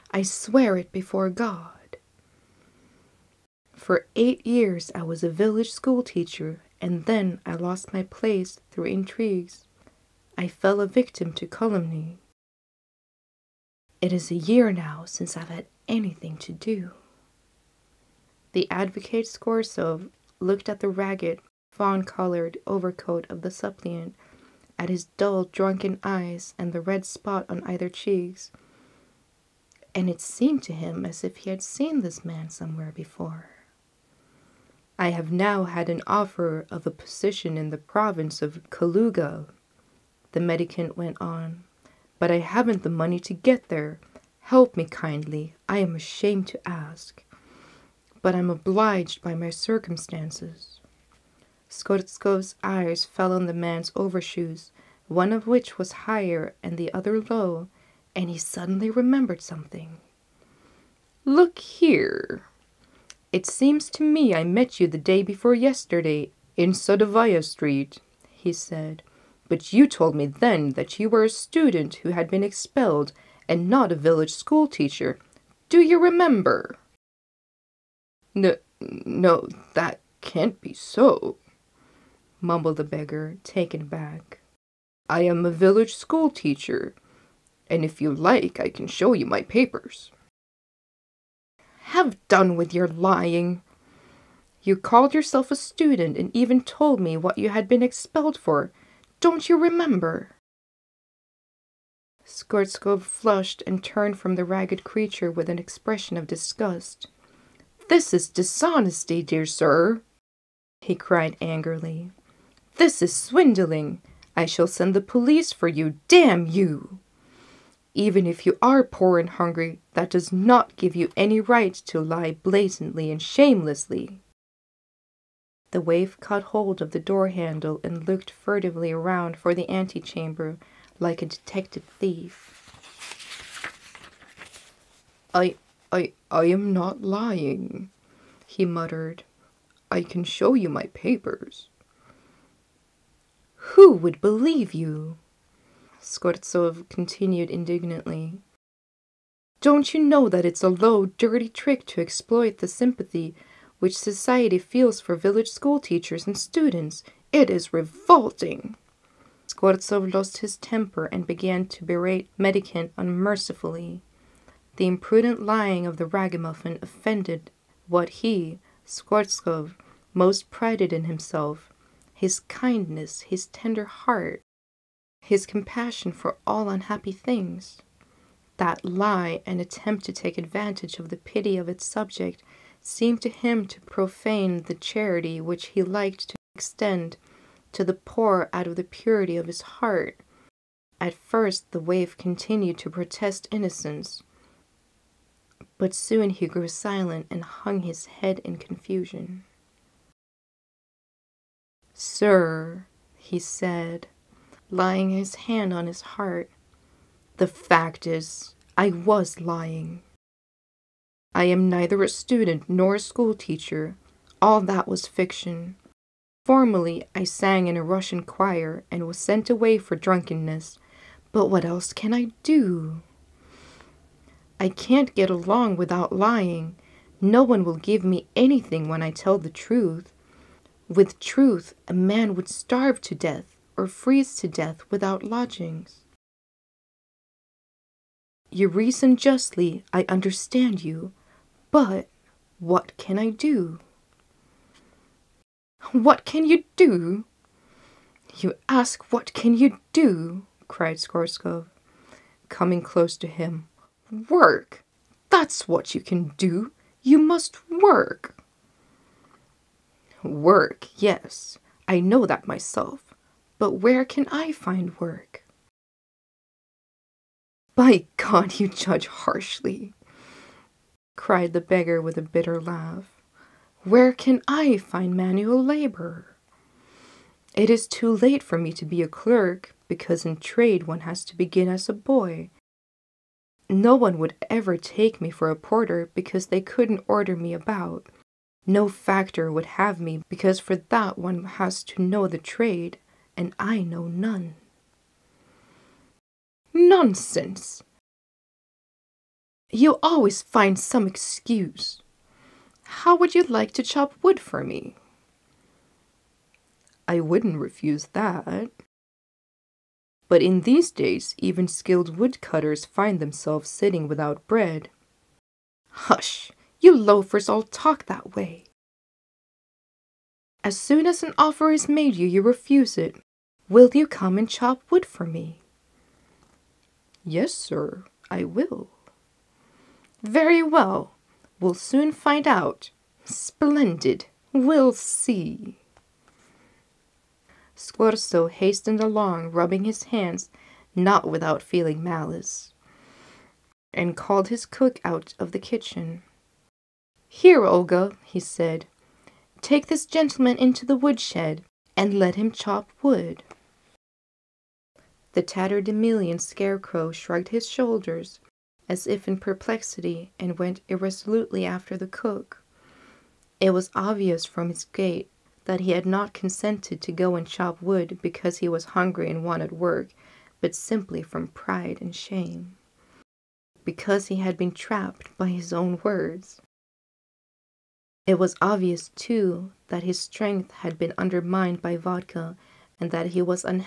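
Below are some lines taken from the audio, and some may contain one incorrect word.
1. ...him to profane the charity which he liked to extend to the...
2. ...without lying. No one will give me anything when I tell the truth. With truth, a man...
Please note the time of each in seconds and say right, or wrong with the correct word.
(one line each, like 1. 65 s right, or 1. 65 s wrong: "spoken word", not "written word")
1. 183 s right
2. 225 s right.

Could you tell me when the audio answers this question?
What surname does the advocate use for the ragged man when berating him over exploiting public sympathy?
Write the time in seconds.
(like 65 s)
162 s.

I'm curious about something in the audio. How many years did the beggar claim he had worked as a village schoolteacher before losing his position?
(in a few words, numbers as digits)
8.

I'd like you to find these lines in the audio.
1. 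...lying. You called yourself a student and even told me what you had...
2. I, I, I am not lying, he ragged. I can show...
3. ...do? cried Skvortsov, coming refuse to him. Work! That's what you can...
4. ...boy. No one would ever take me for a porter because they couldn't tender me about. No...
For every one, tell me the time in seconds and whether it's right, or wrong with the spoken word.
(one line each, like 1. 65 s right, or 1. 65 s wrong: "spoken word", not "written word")
1. 92 s right
2. 135 s wrong: "muttered", not "ragged"
3. 249 s wrong: "close", not "refuse"
4. 281 s wrong: "order", not "tender".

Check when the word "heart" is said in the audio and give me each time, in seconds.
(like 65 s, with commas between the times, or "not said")
173 s, 189 s, 206 s.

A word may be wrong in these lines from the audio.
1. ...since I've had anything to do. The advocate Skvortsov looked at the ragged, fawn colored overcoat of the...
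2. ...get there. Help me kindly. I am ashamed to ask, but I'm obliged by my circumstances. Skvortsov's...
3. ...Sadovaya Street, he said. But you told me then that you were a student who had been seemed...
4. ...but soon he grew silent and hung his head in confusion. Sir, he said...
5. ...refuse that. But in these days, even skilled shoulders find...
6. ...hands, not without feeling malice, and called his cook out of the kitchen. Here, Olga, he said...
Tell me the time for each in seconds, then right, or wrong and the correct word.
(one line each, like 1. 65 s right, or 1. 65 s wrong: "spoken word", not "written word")
1. 15 s right
2. 43 s right
3. 66 s wrong: "expelled", not "seemed"
4. 195 s right
5. 307 s wrong: "woodcutters", not "shoulders"
6. 340 s right.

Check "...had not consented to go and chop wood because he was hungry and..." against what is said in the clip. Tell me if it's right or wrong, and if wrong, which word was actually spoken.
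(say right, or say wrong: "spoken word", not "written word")
right.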